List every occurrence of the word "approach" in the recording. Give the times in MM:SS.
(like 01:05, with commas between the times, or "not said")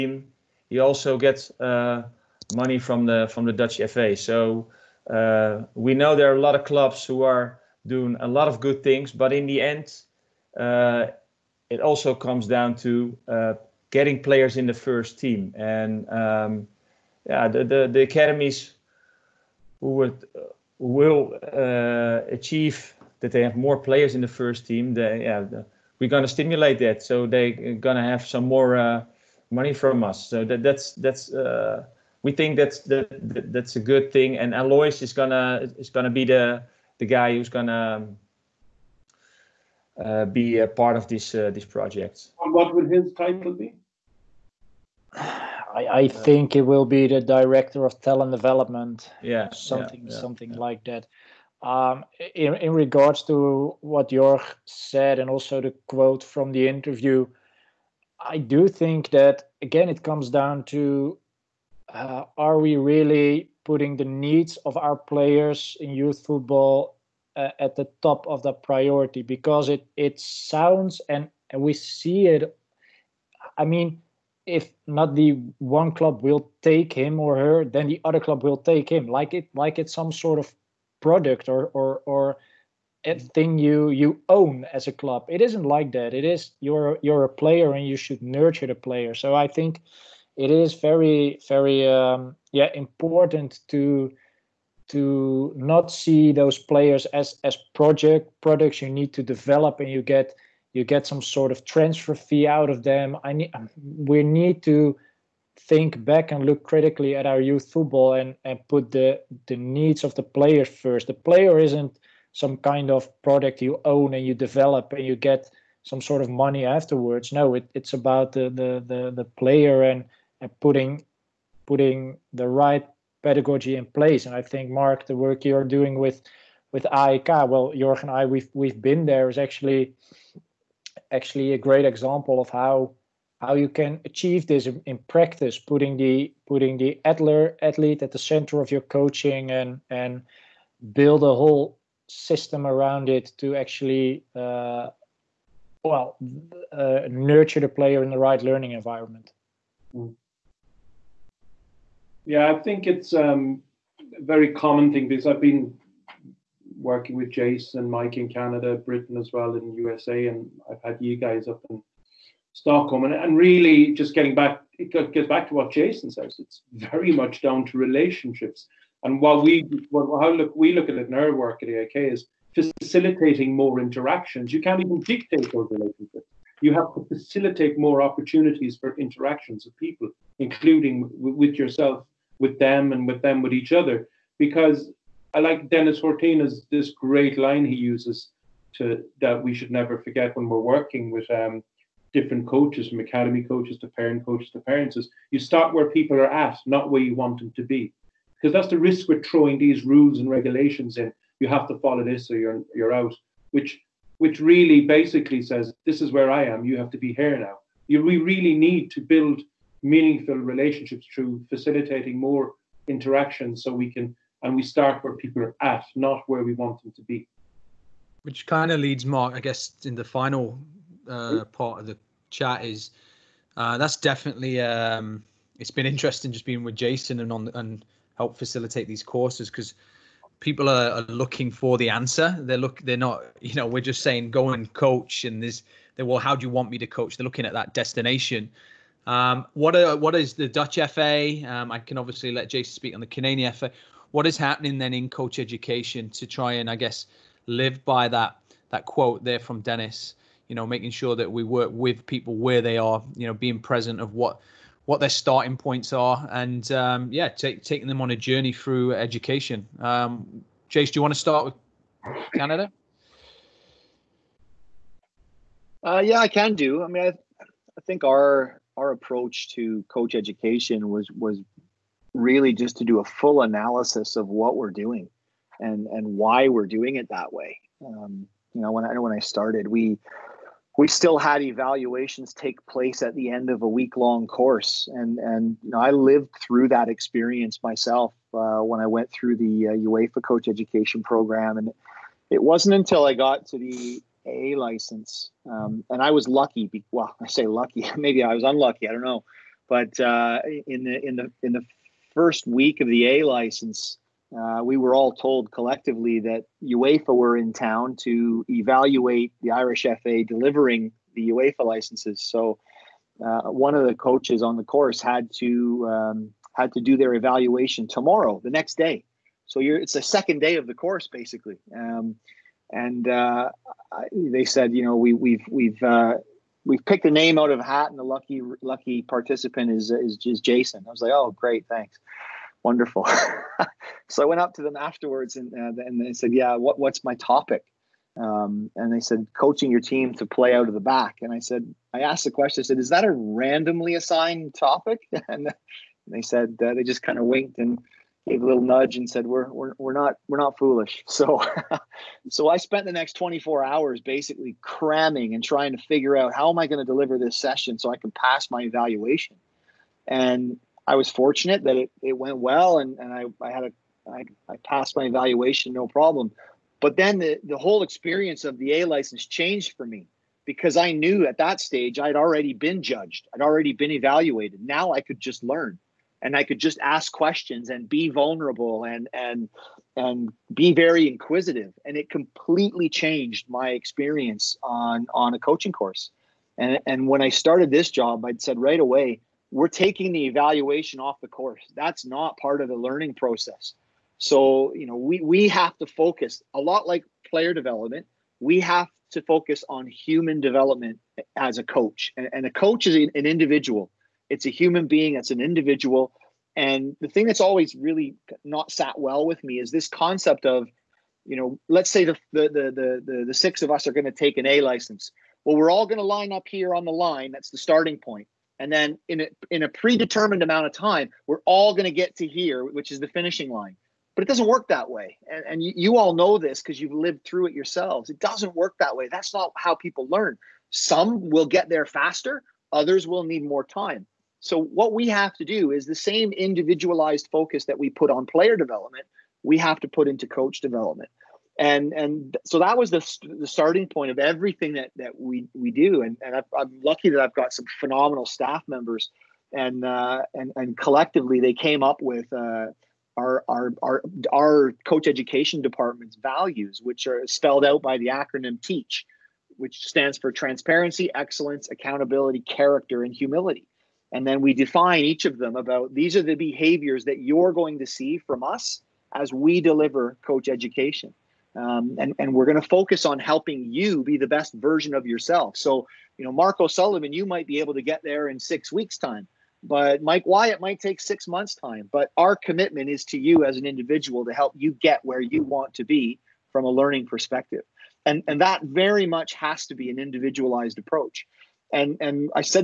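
04:28, 08:10.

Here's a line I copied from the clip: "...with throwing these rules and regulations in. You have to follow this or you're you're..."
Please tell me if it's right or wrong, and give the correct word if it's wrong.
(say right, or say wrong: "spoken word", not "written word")
right.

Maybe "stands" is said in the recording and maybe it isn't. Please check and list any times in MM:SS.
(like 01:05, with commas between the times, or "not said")
07:39.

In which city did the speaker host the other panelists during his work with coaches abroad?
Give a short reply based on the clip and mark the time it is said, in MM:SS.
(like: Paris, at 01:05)
Stockholm, at 02:42.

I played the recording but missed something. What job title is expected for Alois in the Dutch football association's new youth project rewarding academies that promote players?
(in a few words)
Director of talent development.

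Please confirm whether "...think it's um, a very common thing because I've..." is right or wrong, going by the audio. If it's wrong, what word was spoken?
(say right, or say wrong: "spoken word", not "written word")
right.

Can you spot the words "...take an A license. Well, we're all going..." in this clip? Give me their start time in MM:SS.
06:54.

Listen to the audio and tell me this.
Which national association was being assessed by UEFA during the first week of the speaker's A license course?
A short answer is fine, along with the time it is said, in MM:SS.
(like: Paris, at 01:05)
Irish FA, at 05:09.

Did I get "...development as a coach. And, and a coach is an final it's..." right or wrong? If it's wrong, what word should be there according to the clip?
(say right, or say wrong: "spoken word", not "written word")
wrong: "individual", not "final".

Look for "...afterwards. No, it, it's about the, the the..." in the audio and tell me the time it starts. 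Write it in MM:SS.
01:56.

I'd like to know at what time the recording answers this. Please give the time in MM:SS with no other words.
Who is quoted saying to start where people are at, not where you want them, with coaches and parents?
03:05.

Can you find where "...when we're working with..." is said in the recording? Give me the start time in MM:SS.
03:10.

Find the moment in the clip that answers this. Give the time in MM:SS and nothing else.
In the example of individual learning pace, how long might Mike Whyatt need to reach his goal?
08:00.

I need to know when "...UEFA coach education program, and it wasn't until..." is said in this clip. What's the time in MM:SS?
04:49.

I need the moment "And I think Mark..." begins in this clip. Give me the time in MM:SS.
02:04.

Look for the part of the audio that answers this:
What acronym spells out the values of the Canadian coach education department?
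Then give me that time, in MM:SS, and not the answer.
07:38.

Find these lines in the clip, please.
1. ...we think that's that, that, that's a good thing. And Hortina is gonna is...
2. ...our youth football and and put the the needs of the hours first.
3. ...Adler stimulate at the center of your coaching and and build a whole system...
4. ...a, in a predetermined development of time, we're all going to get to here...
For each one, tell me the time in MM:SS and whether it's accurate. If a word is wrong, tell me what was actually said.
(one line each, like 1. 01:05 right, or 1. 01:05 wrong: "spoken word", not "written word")
1. 00:32 wrong: "Alois", not "Hortina"
2. 01:47 wrong: "players", not "hours"
3. 02:17 wrong: "athlete", not "stimulate"
4. 06:59 wrong: "amount", not "development".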